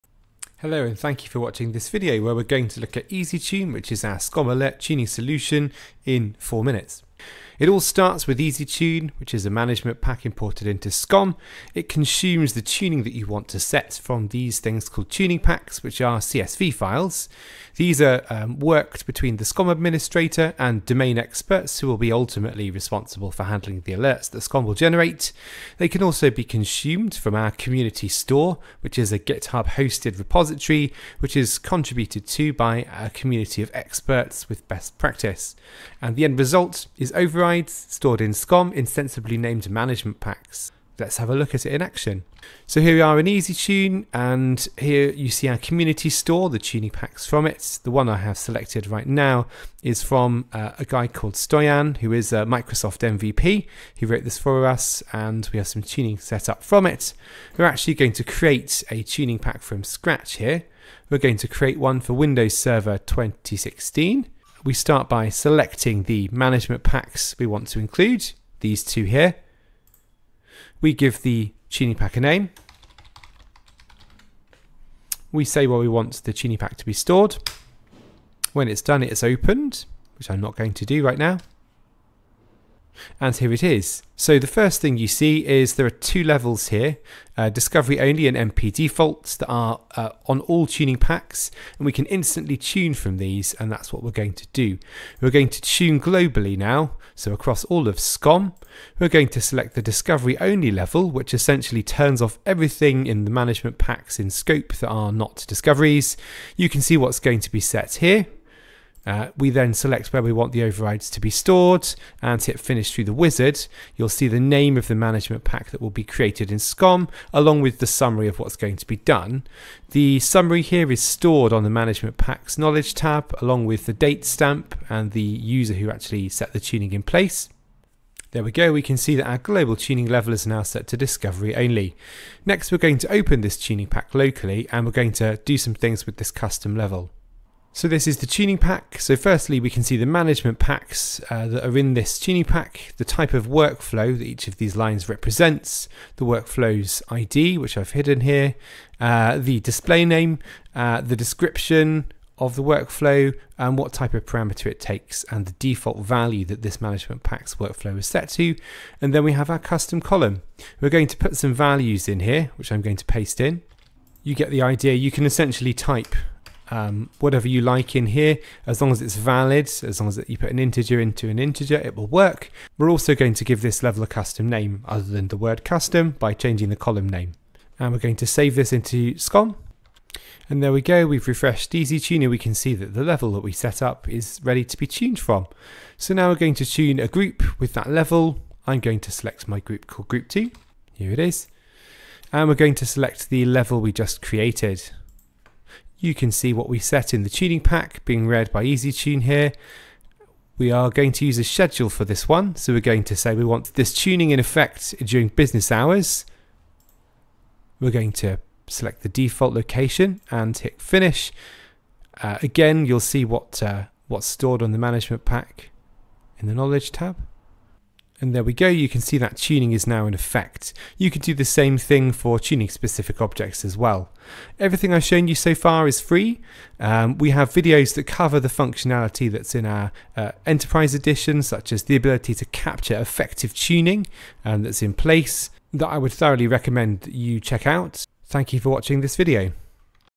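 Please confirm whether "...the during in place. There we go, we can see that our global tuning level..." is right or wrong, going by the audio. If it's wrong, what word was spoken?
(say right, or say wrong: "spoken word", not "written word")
wrong: "tuning", not "during".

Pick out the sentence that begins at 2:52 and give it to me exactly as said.
We're also going to give this level a custom name other than the word custom by changing the column name.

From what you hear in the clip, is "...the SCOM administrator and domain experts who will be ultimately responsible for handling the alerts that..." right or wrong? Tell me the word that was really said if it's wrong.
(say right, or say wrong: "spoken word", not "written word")
right.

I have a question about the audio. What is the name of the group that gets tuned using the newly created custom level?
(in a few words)
group two.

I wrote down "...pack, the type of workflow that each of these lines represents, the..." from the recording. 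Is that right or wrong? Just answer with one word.
right.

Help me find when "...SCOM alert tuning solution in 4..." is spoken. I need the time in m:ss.
0:04.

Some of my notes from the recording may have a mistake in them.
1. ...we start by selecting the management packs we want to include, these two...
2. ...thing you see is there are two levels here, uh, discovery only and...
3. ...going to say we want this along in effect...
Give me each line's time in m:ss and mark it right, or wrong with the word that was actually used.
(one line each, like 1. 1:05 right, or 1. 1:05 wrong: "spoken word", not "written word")
1. 1:04 right
2. 1:24 right
3. 3:22 wrong: "tuning", not "along".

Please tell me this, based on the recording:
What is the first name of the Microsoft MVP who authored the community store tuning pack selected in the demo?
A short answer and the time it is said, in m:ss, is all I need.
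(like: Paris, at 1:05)
Stoyan, at 0:51.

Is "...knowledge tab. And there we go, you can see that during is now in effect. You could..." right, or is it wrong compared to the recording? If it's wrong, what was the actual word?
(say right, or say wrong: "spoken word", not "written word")
wrong: "tuning", not "during".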